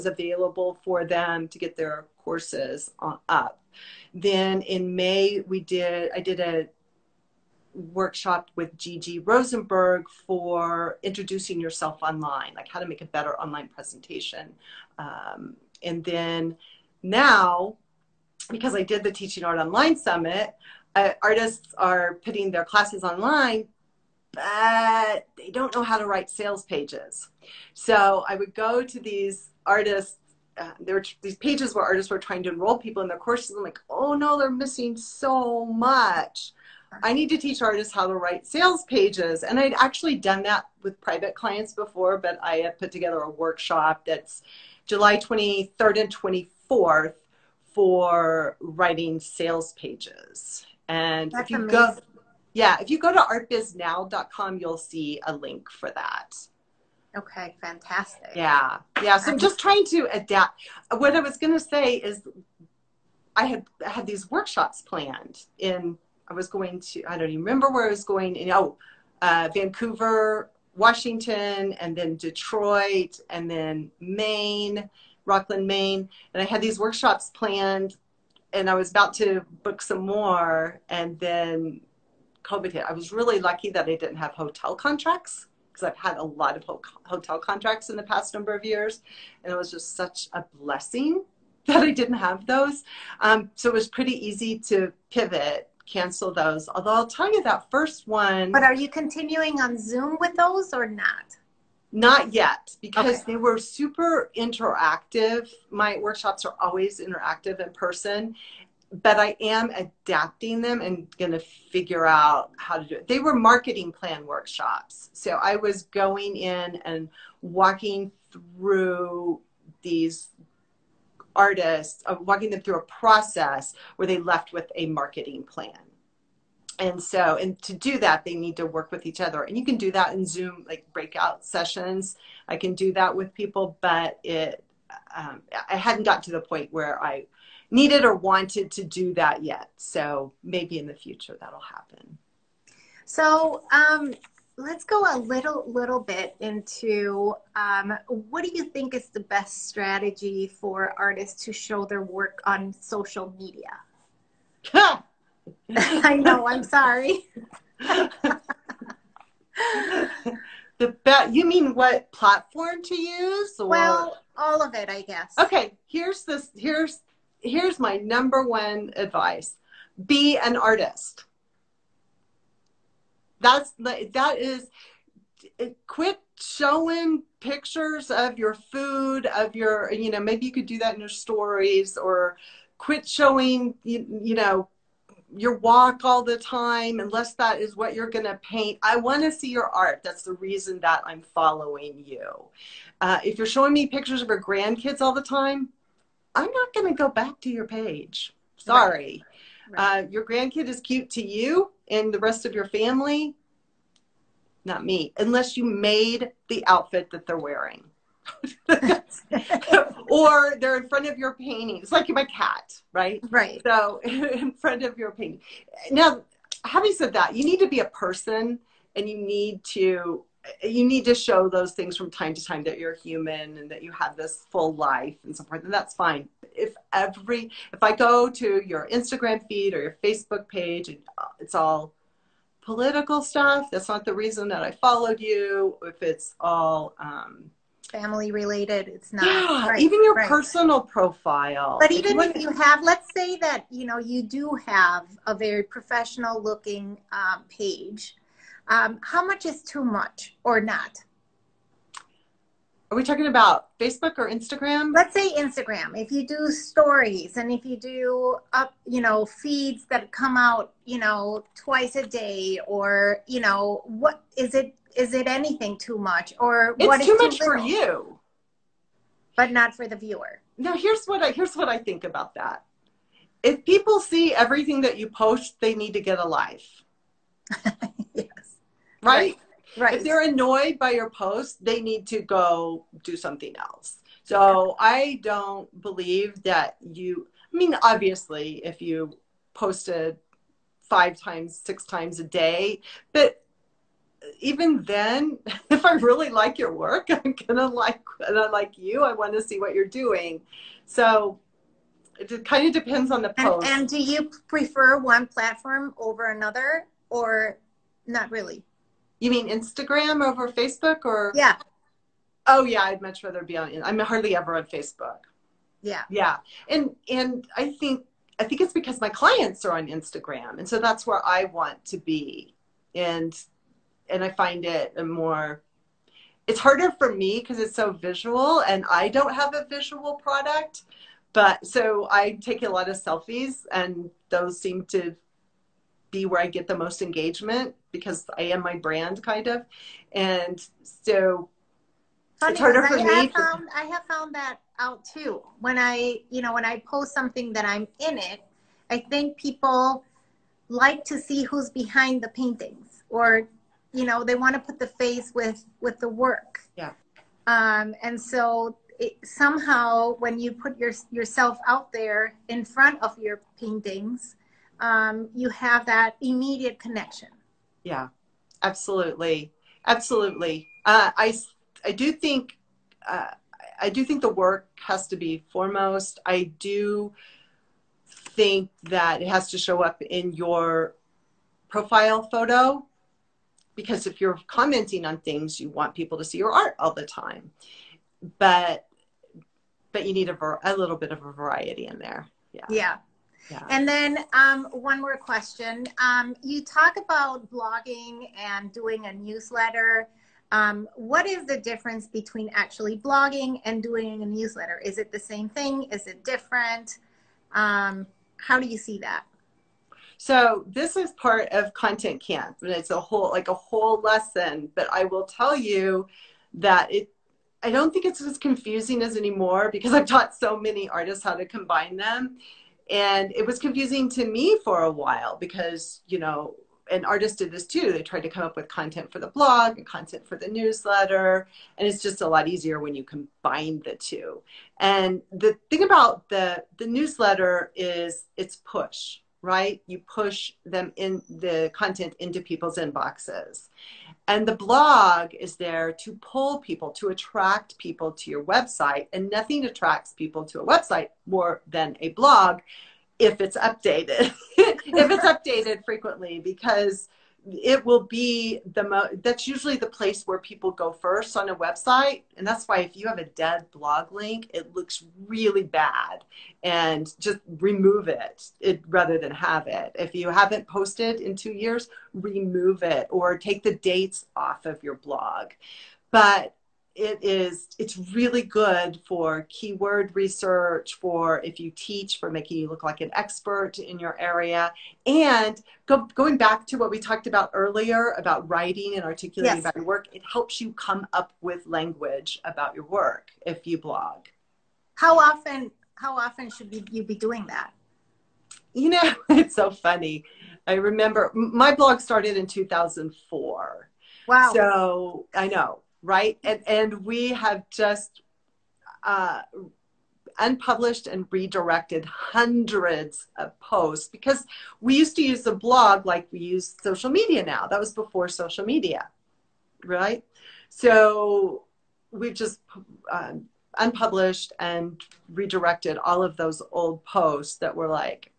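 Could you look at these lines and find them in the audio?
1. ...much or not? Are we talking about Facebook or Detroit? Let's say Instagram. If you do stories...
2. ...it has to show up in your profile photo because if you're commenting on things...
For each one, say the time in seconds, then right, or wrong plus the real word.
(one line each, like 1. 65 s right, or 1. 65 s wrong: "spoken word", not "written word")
1. 249 s wrong: "Instagram", not "Detroit"
2. 379 s right.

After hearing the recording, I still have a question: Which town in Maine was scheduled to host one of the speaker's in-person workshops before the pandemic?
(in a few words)
Rockland.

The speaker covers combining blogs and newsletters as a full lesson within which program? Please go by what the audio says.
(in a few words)
Content Camp.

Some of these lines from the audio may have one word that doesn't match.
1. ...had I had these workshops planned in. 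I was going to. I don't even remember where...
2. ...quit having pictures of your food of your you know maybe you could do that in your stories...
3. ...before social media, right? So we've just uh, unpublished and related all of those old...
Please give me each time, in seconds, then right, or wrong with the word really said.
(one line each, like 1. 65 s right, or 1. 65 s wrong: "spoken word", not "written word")
1. 63 s right
2. 175 s wrong: "showing", not "having"
3. 517 s wrong: "redirected", not "related".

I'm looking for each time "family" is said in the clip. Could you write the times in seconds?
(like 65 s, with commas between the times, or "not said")
202 s, 237 s.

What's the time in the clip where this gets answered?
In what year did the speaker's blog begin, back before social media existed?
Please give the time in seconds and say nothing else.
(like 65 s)
502 s.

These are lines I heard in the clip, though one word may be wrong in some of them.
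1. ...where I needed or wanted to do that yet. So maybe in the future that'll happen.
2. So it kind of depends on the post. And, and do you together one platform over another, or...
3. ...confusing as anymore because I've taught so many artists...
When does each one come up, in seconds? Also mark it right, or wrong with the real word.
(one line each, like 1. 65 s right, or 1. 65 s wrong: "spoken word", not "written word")
1. 136 s right
2. 300 s wrong: "prefer", not "together"
3. 418 s right.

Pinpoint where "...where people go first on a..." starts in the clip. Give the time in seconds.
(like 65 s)
460 s.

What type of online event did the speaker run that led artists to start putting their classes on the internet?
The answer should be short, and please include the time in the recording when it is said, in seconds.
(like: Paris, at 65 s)
Teaching Art Online Summit, at 19 s.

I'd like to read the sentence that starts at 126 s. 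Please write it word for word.
And so, and to do that, they need to work with each other.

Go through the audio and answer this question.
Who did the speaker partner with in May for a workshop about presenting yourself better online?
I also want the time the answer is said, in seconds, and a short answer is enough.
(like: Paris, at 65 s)
Gigi Rosenberg, at 8 s.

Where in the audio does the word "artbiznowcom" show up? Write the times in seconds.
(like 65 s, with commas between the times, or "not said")
53 s.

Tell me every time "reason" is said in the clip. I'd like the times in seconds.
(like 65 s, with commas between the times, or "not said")
190 s, 234 s.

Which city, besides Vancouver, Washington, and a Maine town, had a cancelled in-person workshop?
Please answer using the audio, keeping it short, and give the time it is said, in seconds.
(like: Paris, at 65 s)
Detroit, at 72 s.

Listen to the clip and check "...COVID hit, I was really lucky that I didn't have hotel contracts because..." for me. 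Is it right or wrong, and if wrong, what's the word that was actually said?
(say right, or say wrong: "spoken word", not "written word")
right.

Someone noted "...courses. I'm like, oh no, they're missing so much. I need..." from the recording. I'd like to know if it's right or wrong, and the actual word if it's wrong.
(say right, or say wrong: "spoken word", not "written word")
right.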